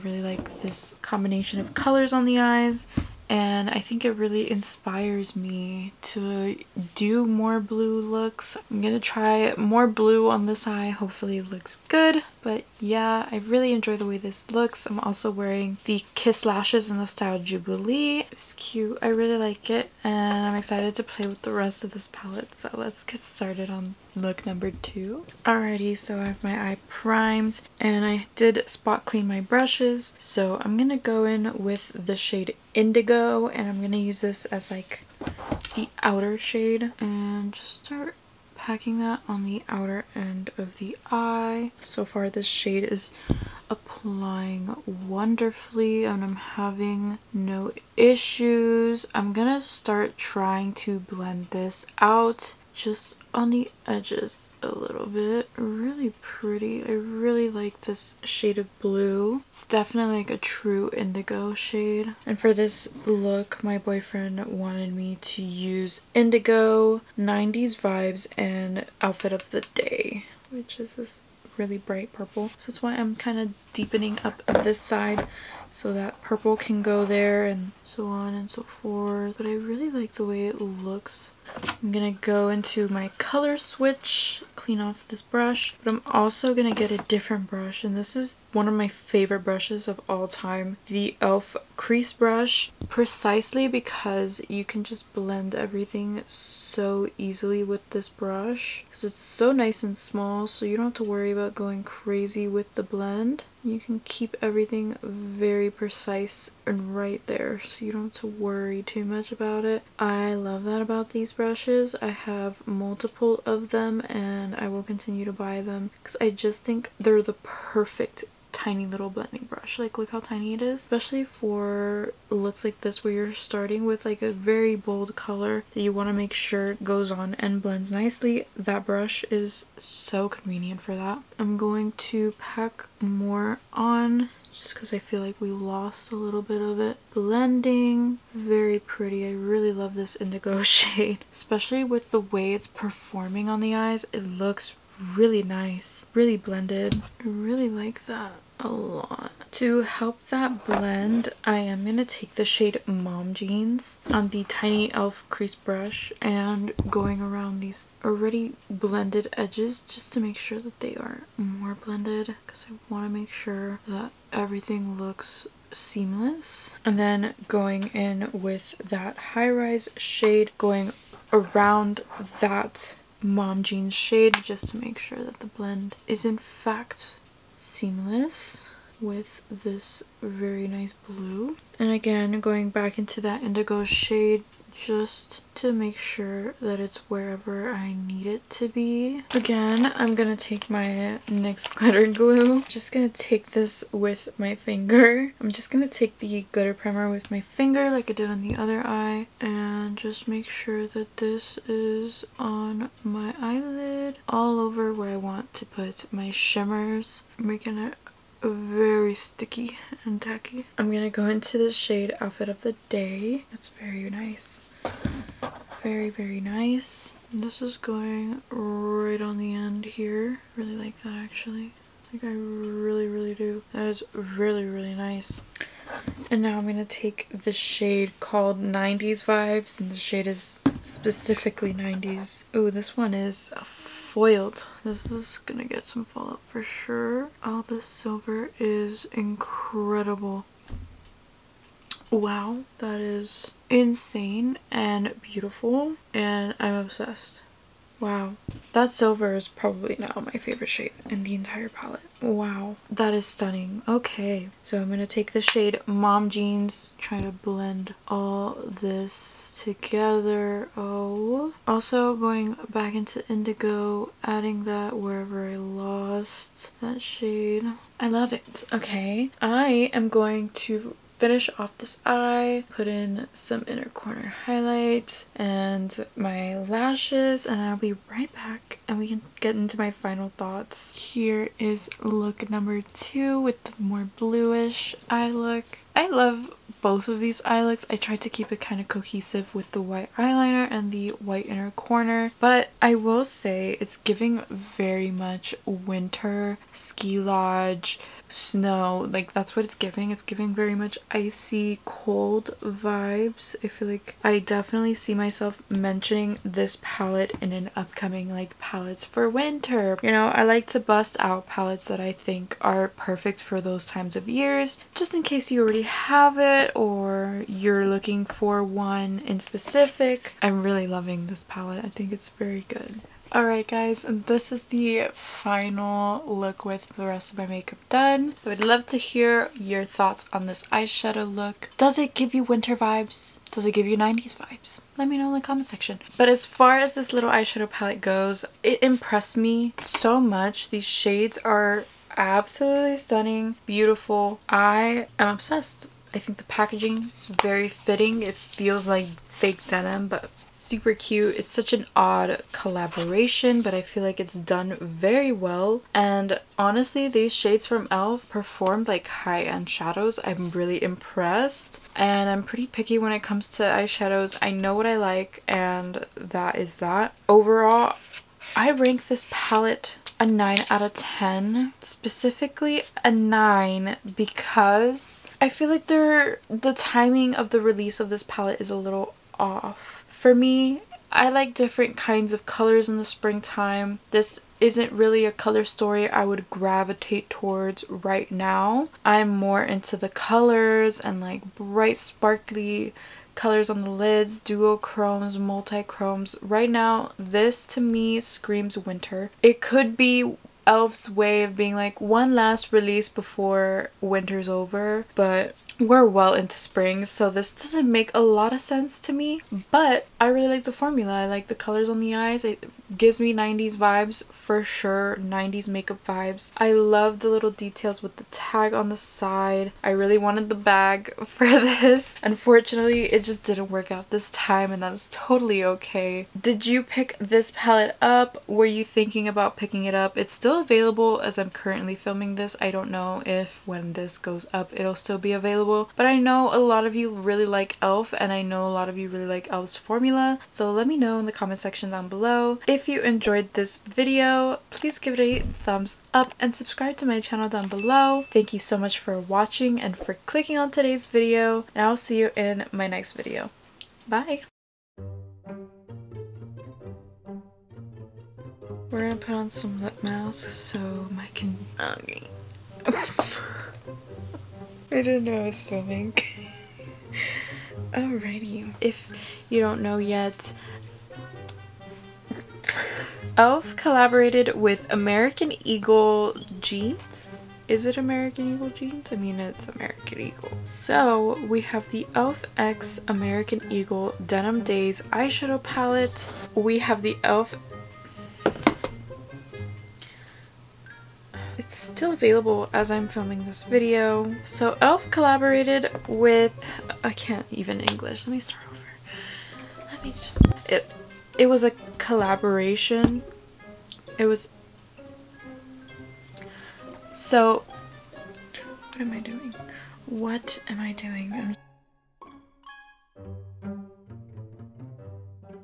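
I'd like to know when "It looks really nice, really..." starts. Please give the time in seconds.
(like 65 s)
144 s.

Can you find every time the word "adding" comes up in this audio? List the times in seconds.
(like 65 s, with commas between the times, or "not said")
264 s.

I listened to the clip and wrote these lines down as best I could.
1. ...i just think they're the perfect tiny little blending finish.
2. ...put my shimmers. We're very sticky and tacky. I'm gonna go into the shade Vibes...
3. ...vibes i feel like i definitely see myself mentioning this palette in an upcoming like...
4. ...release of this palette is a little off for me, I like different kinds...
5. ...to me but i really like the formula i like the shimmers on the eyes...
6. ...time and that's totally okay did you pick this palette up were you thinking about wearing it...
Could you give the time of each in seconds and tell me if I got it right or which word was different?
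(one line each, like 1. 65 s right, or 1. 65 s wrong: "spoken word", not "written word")
1. 116 s wrong: "brush", not "finish"
2. 205 s wrong: "Outfit", not "Vibes"
3. 302 s right
4. 377 s right
5. 408 s wrong: "colors", not "shimmers"
6. 424 s wrong: "picking", not "wearing".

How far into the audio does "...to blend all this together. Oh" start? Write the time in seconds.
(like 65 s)
257 s.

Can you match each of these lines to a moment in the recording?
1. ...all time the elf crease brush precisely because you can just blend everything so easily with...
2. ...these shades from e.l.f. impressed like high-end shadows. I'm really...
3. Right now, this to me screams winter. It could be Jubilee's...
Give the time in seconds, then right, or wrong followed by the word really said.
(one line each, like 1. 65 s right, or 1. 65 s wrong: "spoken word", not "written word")
1. 90 s right
2. 357 s wrong: "performed", not "impressed"
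3. 396 s wrong: "Elf", not "Jubilee".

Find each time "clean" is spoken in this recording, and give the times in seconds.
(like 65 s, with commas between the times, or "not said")
29 s, 84 s.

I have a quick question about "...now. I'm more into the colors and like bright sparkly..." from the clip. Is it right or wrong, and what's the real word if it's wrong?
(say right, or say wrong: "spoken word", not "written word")
right.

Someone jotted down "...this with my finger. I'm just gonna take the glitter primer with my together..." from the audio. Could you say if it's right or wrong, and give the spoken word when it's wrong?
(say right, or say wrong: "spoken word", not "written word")
wrong: "finger", not "together".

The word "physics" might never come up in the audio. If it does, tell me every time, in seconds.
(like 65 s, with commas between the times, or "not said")
not said.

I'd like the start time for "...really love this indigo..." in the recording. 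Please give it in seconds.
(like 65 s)
139 s.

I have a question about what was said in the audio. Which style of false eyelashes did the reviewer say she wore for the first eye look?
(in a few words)
Jubilee.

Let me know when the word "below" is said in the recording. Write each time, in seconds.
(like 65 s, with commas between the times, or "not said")
442 s, 447 s.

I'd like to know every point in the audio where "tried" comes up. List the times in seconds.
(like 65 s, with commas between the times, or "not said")
287 s.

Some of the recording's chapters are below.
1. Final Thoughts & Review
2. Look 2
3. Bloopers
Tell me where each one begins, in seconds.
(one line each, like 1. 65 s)
1. 322 s
2. 25 s
3. 454 s.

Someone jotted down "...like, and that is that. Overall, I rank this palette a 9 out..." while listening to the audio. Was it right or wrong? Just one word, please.
right.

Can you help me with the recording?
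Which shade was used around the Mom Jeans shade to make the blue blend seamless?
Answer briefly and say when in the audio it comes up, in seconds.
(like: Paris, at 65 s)
High-Rise, at 169 s.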